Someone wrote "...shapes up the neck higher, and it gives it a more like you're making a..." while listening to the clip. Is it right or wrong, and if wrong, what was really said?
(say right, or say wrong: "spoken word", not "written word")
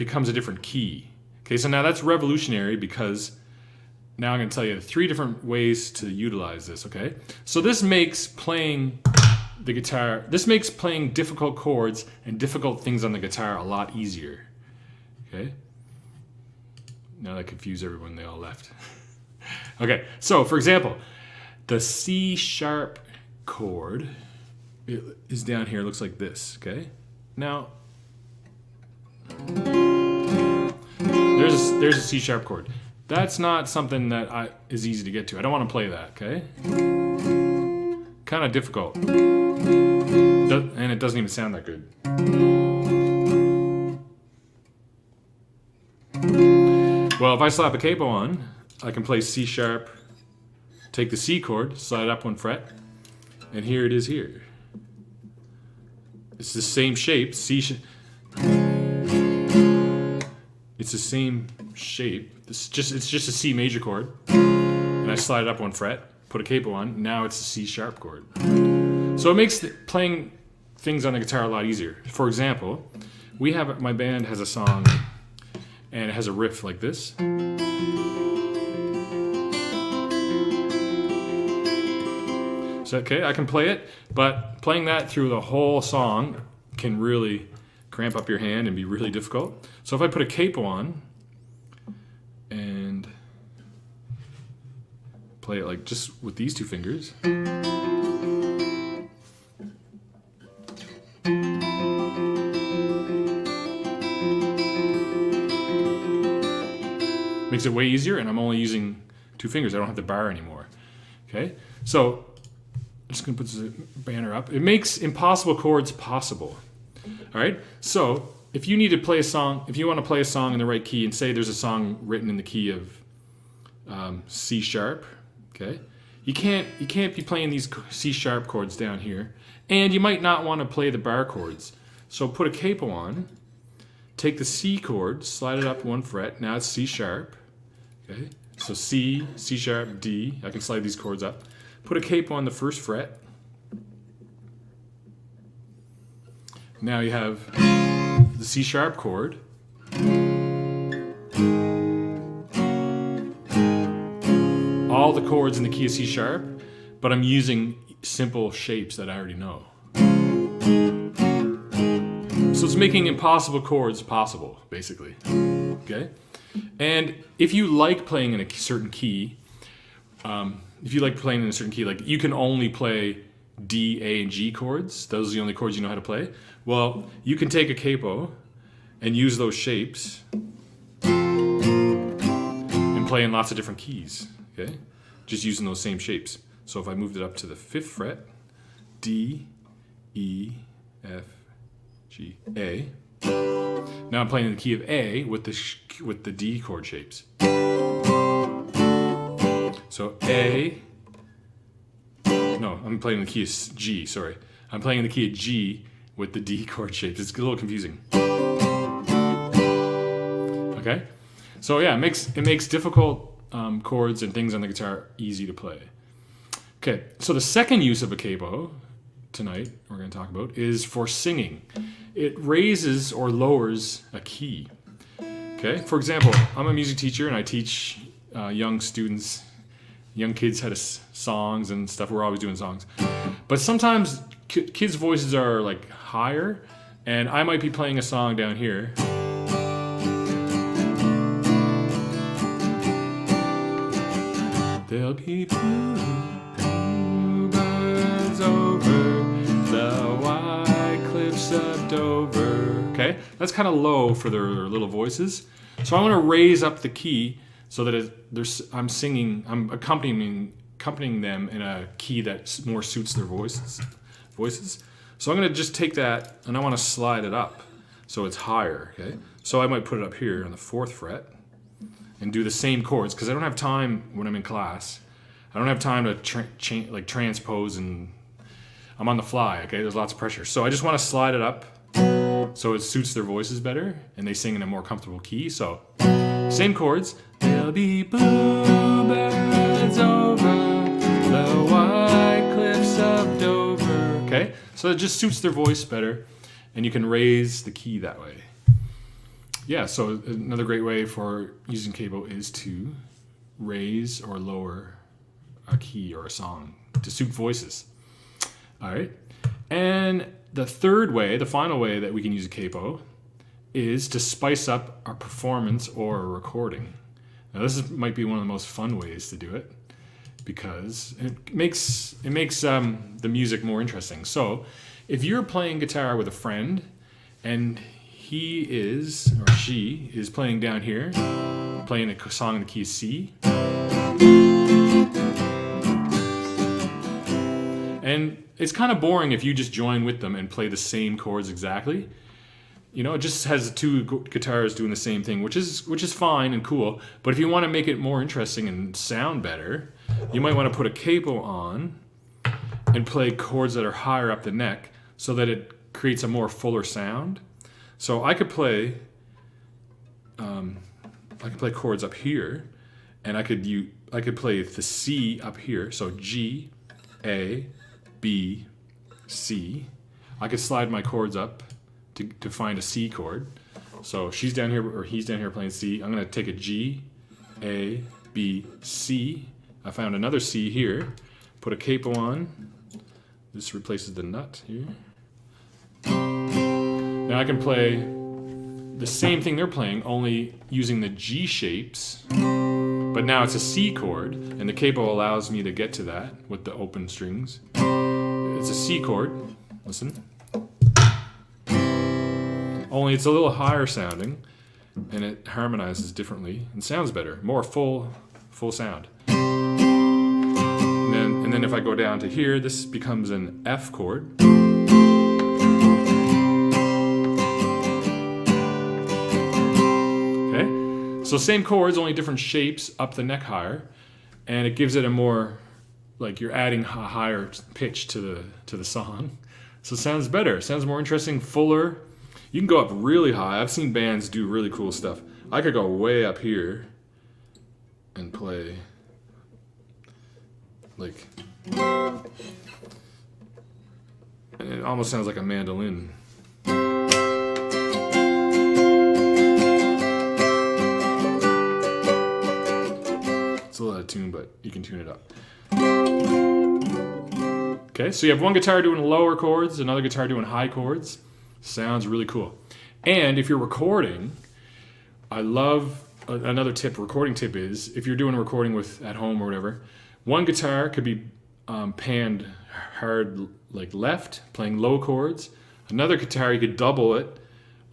wrong: "adding", not "making".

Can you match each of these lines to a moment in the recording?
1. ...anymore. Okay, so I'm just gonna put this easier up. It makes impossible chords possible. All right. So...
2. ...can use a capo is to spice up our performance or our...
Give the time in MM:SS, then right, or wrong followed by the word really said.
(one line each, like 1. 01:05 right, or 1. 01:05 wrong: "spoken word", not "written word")
1. 01:50 wrong: "banner", not "easier"
2. 05:12 right.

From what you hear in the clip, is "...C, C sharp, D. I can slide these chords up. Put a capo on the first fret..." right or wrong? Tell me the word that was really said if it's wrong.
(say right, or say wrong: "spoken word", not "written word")
right.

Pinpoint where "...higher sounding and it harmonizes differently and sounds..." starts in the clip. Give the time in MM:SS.
06:43.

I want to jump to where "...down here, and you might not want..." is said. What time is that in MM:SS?
02:08.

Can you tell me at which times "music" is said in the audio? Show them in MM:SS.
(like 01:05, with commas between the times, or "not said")
03:46, 05:23.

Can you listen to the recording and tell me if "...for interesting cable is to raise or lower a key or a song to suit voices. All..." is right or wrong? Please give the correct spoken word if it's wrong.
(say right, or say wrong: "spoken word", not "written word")
wrong: "using", not "interesting".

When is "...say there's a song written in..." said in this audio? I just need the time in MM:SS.
02:01.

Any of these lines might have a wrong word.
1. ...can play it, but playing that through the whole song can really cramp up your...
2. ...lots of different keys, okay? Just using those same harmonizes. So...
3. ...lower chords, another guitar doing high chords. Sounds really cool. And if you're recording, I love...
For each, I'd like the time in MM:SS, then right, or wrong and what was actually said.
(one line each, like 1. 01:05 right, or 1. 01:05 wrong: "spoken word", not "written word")
1. 01:23 right
2. 03:03 wrong: "shapes", not "harmonizes"
3. 07:39 right.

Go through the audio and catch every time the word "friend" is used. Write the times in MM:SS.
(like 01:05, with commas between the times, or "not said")
05:26.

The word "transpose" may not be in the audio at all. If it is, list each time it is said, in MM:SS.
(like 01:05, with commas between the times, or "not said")
04:37.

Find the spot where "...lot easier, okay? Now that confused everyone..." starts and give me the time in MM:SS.
00:13.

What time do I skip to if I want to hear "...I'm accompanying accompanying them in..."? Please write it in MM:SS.
04:19.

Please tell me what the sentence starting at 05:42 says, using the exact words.
You know, it just has two guitars doing the same thing, which is which is fine and cool.